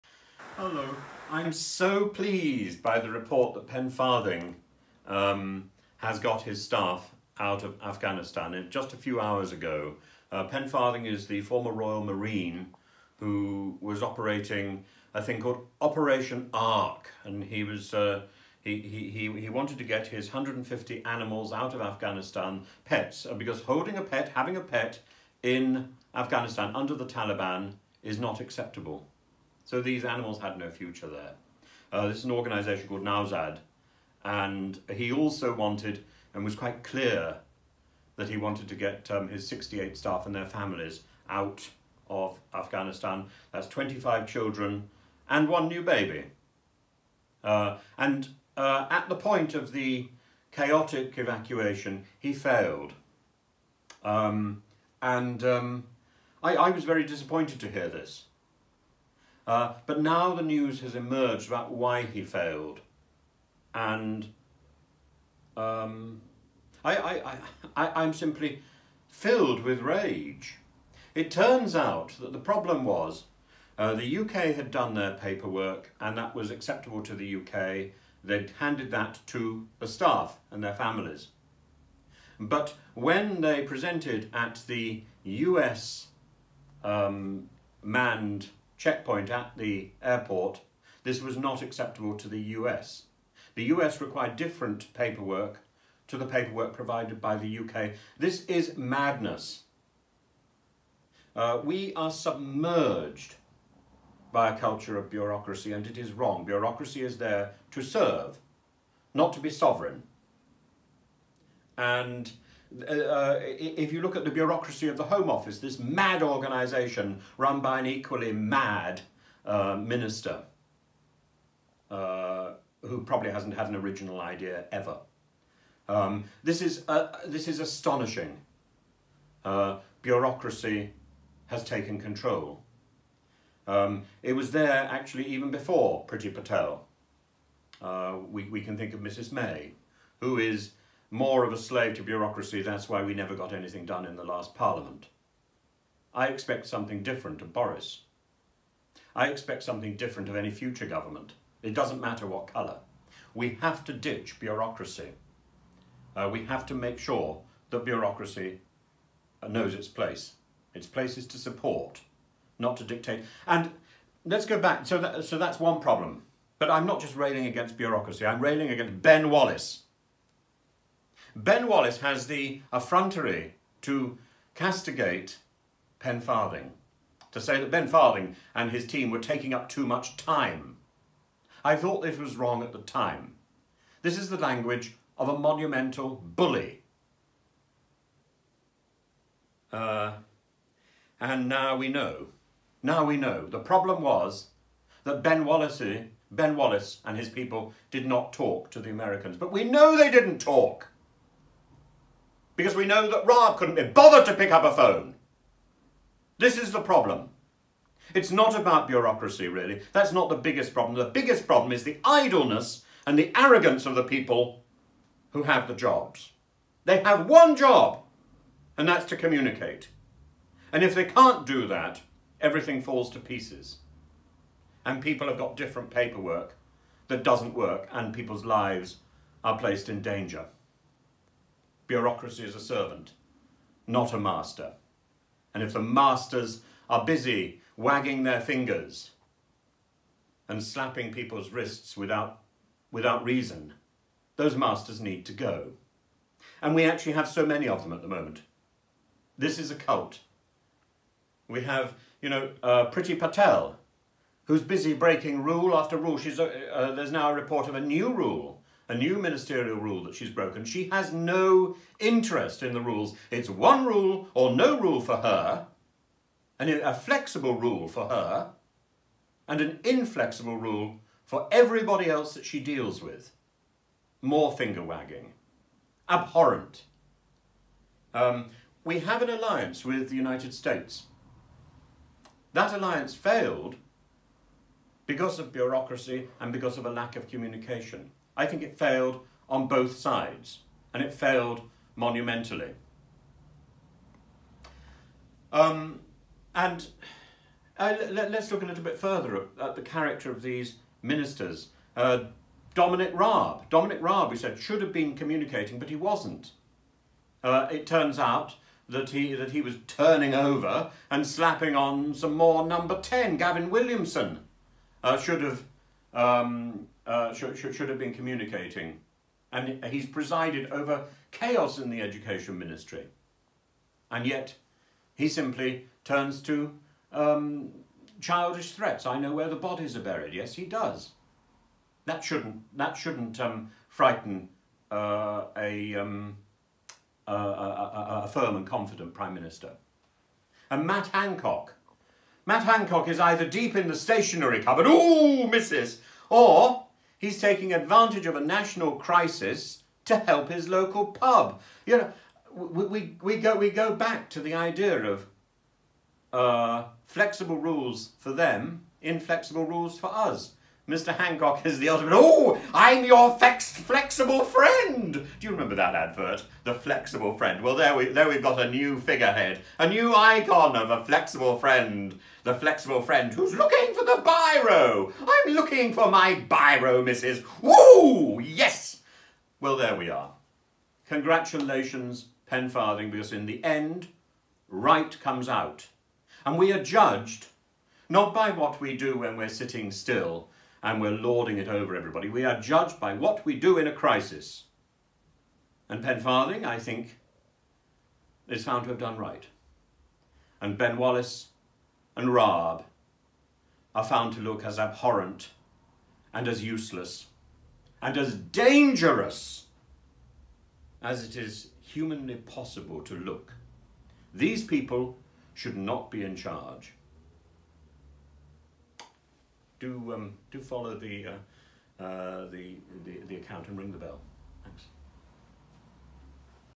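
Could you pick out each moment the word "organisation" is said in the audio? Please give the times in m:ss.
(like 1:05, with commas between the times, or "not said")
0:32, 1:56.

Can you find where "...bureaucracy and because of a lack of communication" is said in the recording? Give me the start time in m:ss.
4:45.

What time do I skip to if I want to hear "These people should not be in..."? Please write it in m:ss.
6:54.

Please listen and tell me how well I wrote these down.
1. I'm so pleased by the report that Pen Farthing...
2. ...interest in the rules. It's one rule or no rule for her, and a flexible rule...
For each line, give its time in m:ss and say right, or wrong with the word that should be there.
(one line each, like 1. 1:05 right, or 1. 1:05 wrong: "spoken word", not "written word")
1. 0:01 right
2. 4:21 right.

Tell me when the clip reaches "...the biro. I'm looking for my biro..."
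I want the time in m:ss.
6:14.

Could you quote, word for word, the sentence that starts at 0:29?
So these animals had no future there.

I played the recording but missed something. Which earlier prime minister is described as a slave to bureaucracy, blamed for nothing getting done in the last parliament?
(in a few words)
Mrs May.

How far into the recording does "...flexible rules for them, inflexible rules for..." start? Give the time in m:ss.
5:57.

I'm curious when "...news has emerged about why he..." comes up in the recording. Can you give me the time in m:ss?
1:00.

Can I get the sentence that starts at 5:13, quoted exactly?
Gavin Williamson uh, should have um, uh, should, should, should have been communicating.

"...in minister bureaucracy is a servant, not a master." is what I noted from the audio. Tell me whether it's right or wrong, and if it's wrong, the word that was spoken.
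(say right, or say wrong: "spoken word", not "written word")
wrong: "danger", not "minister".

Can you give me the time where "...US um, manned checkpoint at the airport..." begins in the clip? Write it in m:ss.
1:25.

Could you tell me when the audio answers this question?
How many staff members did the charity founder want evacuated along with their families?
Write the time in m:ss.
0:39.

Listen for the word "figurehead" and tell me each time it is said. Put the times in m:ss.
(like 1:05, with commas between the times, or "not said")
6:08.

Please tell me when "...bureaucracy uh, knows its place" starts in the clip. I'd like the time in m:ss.
2:37.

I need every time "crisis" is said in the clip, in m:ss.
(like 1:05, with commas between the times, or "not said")
5:48, 6:33.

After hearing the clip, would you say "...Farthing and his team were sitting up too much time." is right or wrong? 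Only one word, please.
wrong.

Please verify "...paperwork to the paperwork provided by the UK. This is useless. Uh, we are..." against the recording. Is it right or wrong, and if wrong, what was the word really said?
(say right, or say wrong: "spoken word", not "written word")
wrong: "madness", not "useless".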